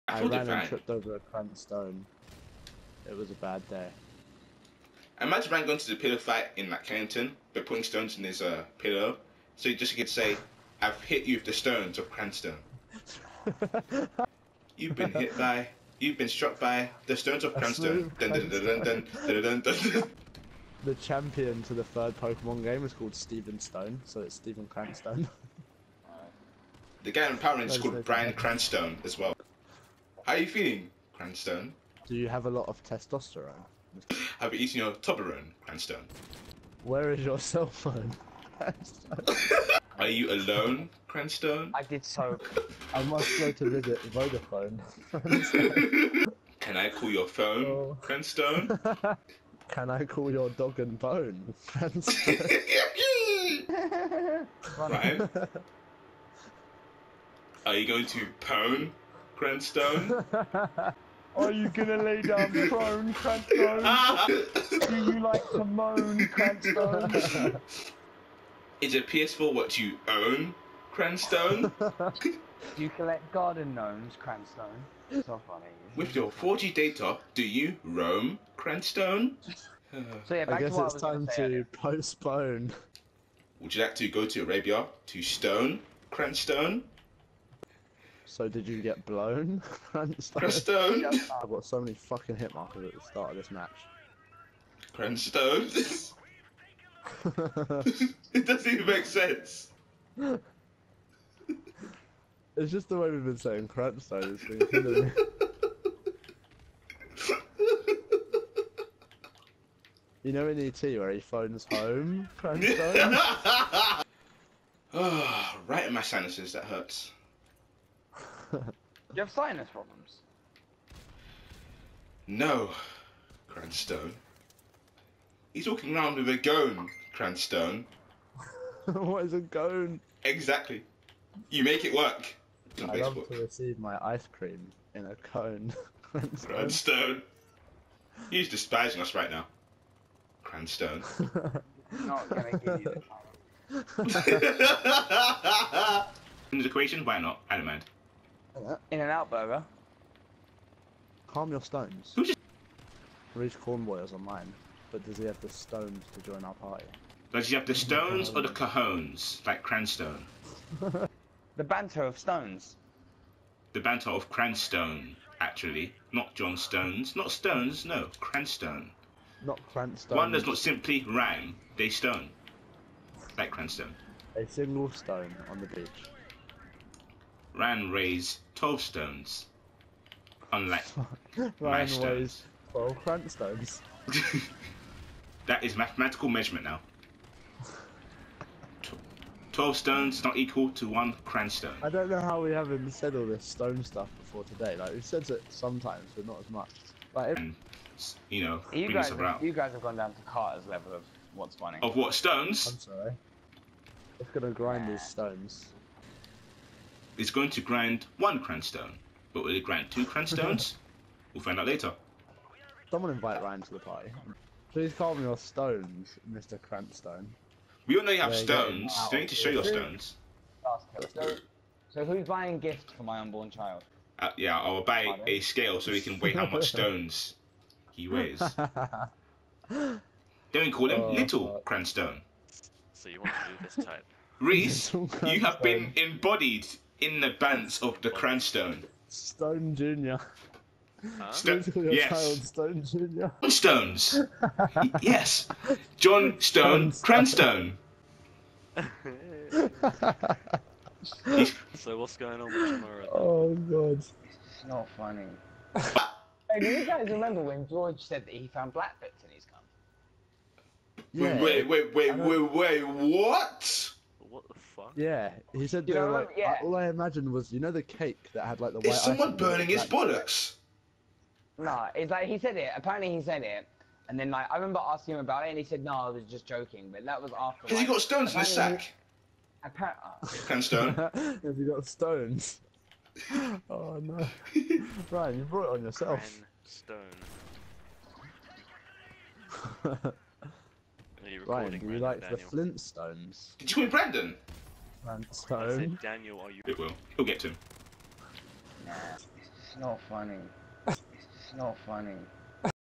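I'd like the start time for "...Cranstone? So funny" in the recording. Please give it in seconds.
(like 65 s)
74 s.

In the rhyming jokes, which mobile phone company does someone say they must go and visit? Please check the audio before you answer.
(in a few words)
Vodafone.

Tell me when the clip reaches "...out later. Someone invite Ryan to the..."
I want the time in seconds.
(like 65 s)
211 s.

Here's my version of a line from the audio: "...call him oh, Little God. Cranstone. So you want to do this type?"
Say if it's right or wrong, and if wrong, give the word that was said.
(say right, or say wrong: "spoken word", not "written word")
right.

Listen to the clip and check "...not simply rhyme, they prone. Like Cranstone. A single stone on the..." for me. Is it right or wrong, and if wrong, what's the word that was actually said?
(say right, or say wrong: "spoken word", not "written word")
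wrong: "stone", not "prone".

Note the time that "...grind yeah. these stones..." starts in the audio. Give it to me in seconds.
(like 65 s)
204 s.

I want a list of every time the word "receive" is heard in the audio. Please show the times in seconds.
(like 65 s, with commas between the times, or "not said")
133 s.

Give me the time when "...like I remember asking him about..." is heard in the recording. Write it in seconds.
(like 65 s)
274 s.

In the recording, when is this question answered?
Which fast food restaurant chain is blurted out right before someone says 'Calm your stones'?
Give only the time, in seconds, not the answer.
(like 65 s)
148 s.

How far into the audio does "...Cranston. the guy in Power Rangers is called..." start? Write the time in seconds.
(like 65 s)
24 s.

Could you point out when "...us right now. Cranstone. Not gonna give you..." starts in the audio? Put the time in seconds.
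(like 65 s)
139 s.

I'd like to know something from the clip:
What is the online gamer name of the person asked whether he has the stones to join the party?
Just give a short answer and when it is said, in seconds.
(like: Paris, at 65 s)
Reach Cornboy, at 153 s.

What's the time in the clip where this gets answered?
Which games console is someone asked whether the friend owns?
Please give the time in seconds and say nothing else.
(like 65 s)
69 s.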